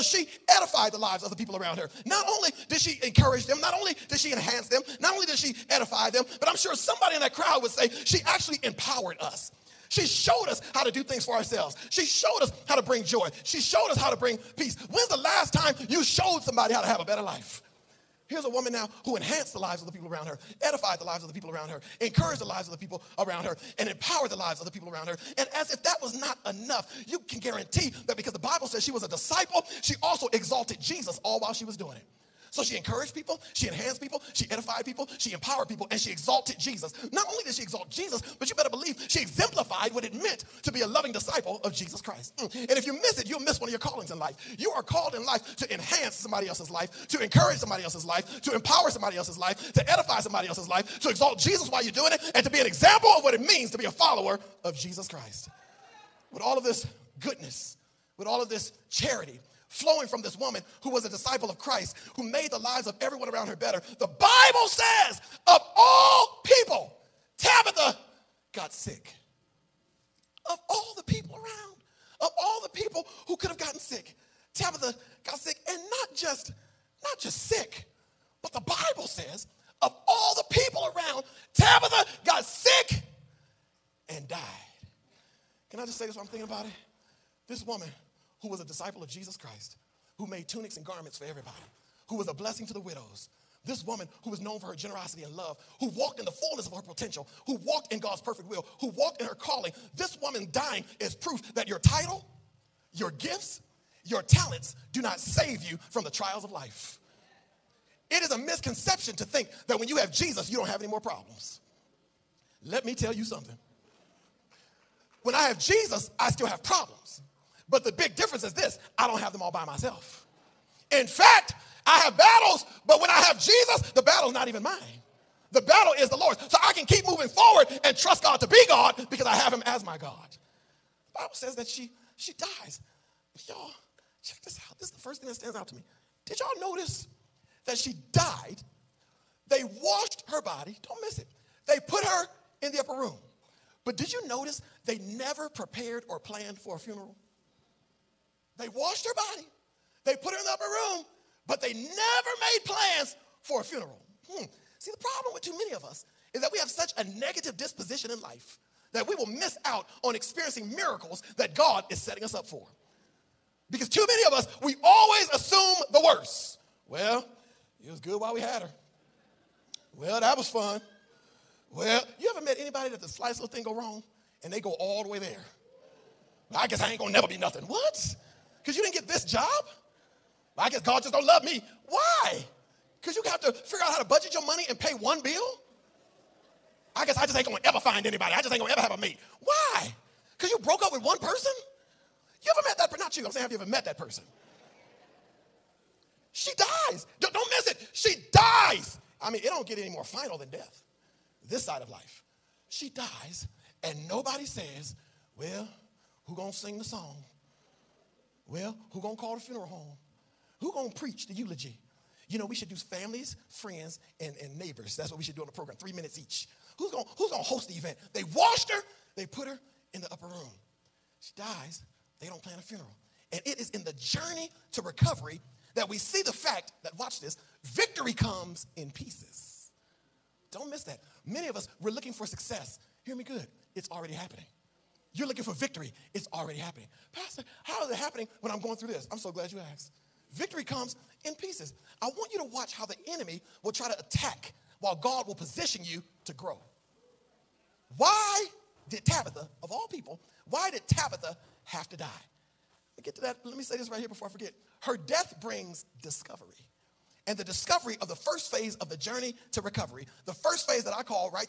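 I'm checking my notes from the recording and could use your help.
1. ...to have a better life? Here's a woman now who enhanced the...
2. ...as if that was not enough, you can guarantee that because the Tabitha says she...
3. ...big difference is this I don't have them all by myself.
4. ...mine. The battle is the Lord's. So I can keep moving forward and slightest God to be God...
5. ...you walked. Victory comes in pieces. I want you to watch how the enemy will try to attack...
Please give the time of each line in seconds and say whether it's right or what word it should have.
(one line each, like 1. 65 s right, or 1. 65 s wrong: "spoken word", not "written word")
1. 16 s right
2. 25 s wrong: "Bible", not "Tabitha"
3. 117 s right
4. 124 s wrong: "trust", not "slightest"
5. 239 s wrong: "asked", not "walked".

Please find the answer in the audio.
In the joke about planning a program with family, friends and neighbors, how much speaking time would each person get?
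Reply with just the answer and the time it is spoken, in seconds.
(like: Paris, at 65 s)
3 minutes each, at 215 s.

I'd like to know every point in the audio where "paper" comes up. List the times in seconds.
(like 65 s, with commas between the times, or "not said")
not said.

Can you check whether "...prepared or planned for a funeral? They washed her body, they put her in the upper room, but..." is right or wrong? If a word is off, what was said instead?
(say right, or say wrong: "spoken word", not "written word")
right.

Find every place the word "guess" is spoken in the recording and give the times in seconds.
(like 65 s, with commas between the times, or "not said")
176 s, 180 s, 187 s.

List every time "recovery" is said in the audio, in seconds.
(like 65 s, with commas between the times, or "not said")
224 s, 259 s.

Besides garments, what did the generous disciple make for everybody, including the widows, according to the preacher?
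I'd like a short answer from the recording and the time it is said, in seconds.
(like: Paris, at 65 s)
tunics, at 90 s.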